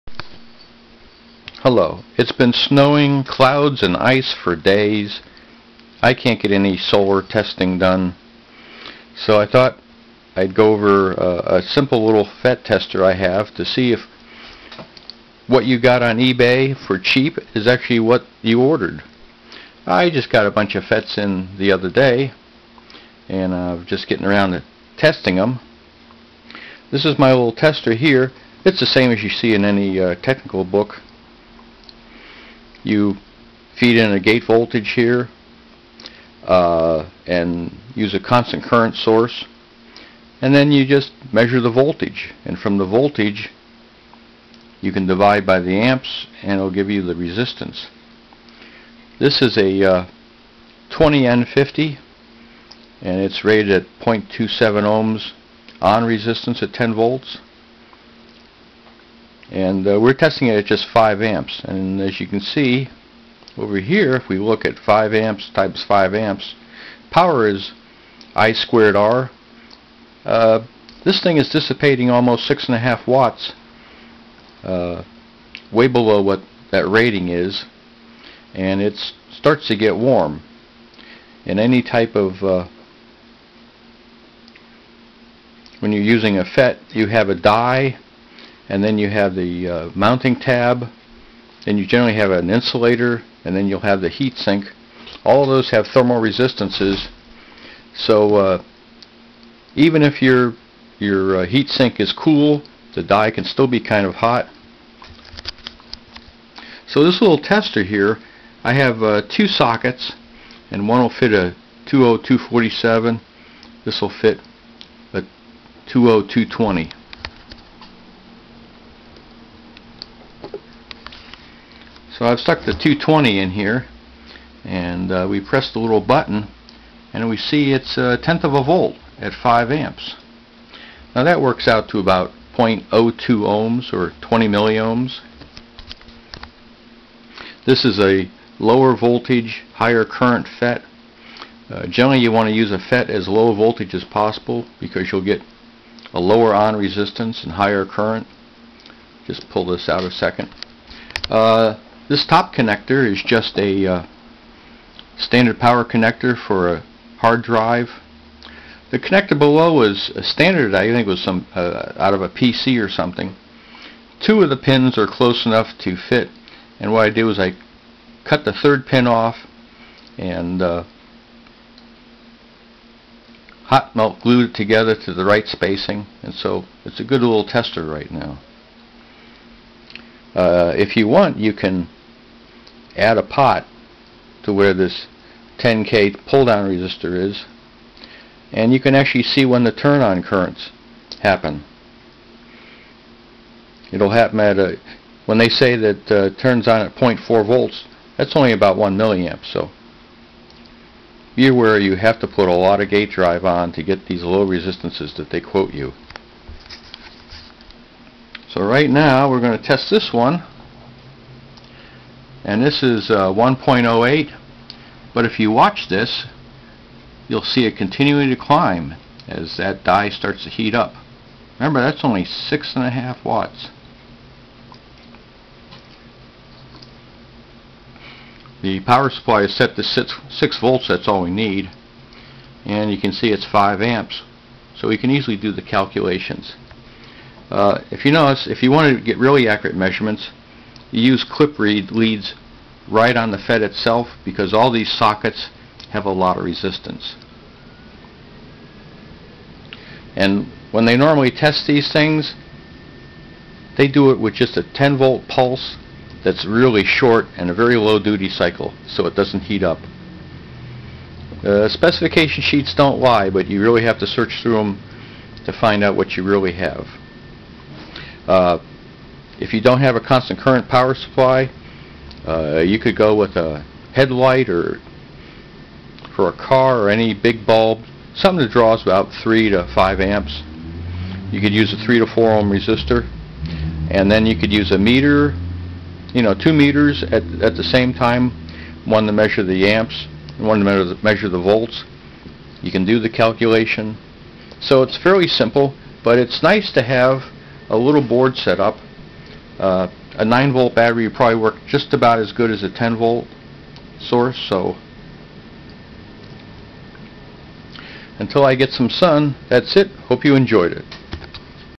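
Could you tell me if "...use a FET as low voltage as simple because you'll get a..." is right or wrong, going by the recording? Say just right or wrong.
wrong.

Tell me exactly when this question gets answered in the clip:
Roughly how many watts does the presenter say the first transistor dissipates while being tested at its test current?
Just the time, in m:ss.
1:12.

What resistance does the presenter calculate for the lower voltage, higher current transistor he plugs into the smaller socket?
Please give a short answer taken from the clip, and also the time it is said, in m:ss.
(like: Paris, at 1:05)
20 milliohms, at 2:14.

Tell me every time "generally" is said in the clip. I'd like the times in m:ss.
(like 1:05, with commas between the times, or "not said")
1:31, 2:21.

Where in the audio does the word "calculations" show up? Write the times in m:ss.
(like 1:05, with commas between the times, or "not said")
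3:55, 4:53.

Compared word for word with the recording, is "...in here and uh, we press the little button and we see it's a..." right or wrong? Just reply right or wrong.
right.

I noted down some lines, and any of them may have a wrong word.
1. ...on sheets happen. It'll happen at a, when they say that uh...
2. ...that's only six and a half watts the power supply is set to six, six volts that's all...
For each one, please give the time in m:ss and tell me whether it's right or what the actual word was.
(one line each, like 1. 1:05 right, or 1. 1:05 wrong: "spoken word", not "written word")
1. 3:10 wrong: "currents", not "sheets"
2. 3:41 right.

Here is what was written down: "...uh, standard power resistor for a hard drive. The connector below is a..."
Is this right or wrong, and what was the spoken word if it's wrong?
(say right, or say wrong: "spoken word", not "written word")
wrong: "connector", not "resistor".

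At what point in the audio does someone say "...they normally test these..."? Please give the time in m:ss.
4:10.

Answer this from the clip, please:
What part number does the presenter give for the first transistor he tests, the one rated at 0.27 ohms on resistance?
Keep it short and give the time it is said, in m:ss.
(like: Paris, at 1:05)
20N50, at 0:50.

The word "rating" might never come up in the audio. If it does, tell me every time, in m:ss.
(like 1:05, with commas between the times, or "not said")
1:16.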